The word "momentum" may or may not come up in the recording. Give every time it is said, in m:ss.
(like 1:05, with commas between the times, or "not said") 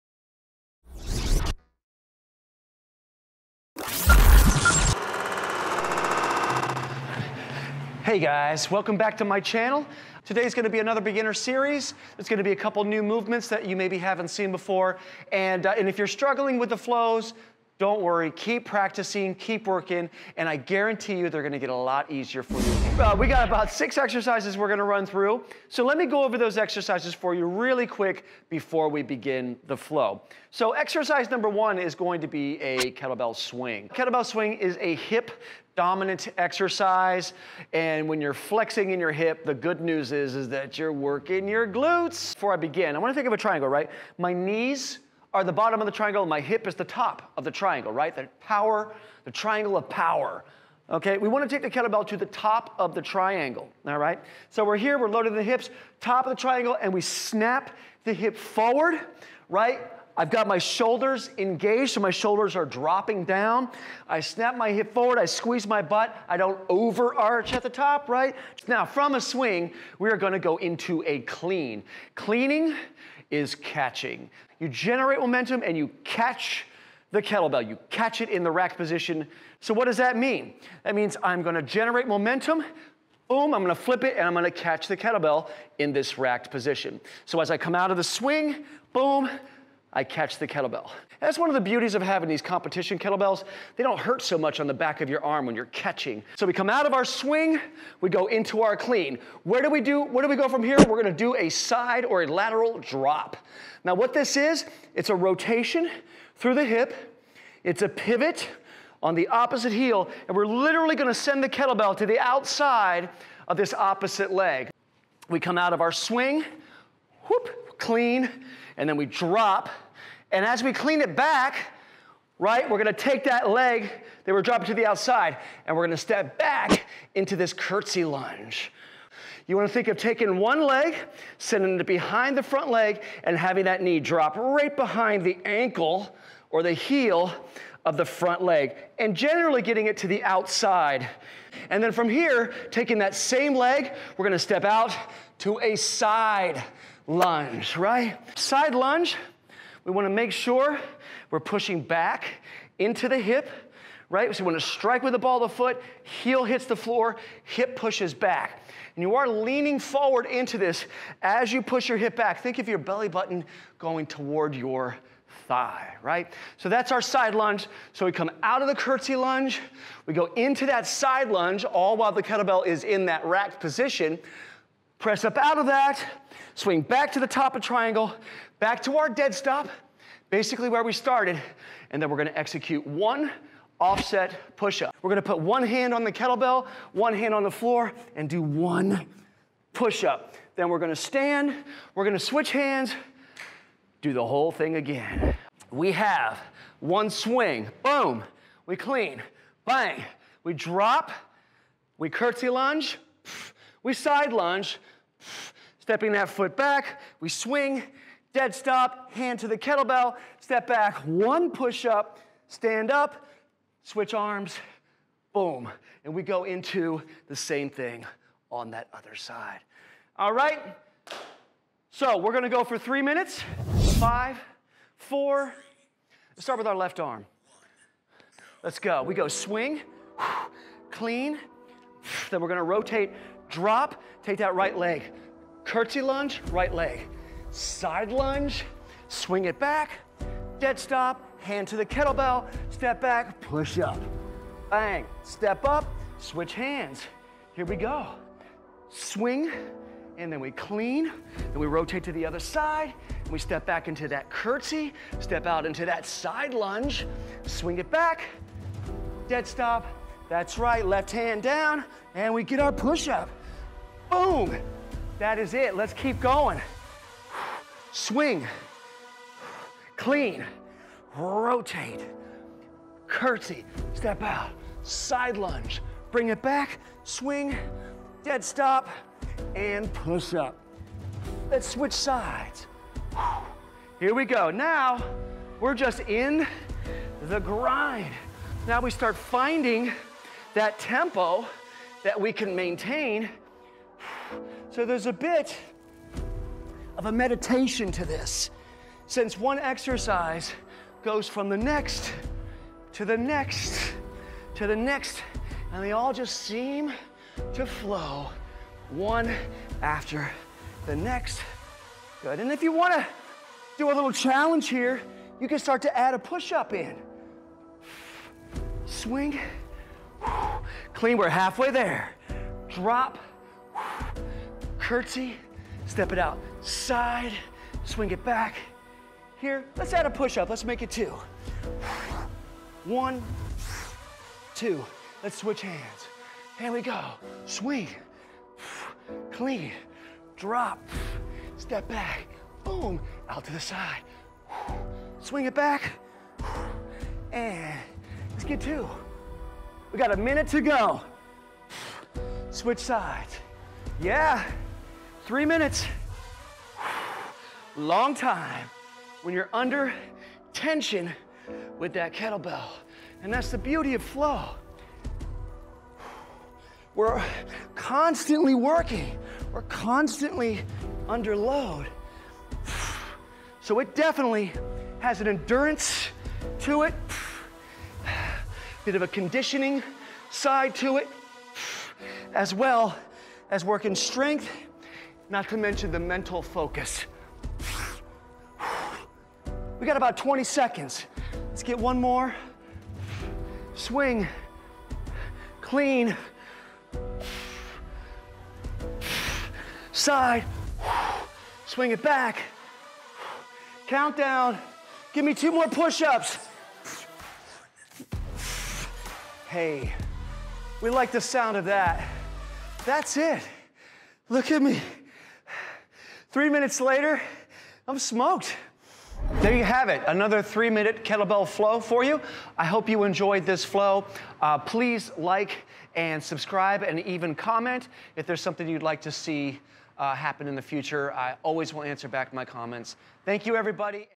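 1:15, 1:22.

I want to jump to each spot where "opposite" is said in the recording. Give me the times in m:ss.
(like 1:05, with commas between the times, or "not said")
1:49, 1:53.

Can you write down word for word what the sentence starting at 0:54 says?
So we're here, we're loaded the hips, top of the triangle, and we snap the hip forward, right?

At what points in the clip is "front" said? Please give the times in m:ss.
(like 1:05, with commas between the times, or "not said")
2:12, 2:18.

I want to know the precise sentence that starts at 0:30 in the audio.
So exercise number one is going to be a kettlebell swing.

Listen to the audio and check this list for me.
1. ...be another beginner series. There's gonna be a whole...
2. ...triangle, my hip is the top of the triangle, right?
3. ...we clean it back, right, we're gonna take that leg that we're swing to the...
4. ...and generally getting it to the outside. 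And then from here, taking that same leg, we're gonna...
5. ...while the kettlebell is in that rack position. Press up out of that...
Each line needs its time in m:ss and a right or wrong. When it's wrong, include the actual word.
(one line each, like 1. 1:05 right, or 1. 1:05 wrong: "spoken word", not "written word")
1. 0:10 wrong: "couple", not "whole"
2. 0:45 right
3. 2:00 wrong: "dropping", not "swing"
4. 2:18 right
5. 2:51 right.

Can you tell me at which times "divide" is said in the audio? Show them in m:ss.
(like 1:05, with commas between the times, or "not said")
not said.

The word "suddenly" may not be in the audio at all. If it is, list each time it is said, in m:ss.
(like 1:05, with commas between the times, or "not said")
not said.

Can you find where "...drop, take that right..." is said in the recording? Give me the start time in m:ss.
3:53.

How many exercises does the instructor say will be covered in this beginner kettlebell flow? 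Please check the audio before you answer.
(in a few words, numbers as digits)
6.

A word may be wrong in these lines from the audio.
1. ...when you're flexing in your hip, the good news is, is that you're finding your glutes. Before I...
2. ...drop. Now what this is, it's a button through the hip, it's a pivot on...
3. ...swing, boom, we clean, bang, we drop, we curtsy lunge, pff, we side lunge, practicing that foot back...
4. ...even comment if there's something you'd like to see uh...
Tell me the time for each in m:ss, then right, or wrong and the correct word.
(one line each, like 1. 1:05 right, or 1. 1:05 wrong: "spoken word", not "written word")
1. 0:38 wrong: "working", not "finding"
2. 1:42 wrong: "rotation", not "button"
3. 3:17 wrong: "stepping", not "practicing"
4. 7:07 right.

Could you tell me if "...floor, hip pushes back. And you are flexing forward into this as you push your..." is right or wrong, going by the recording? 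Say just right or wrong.
wrong.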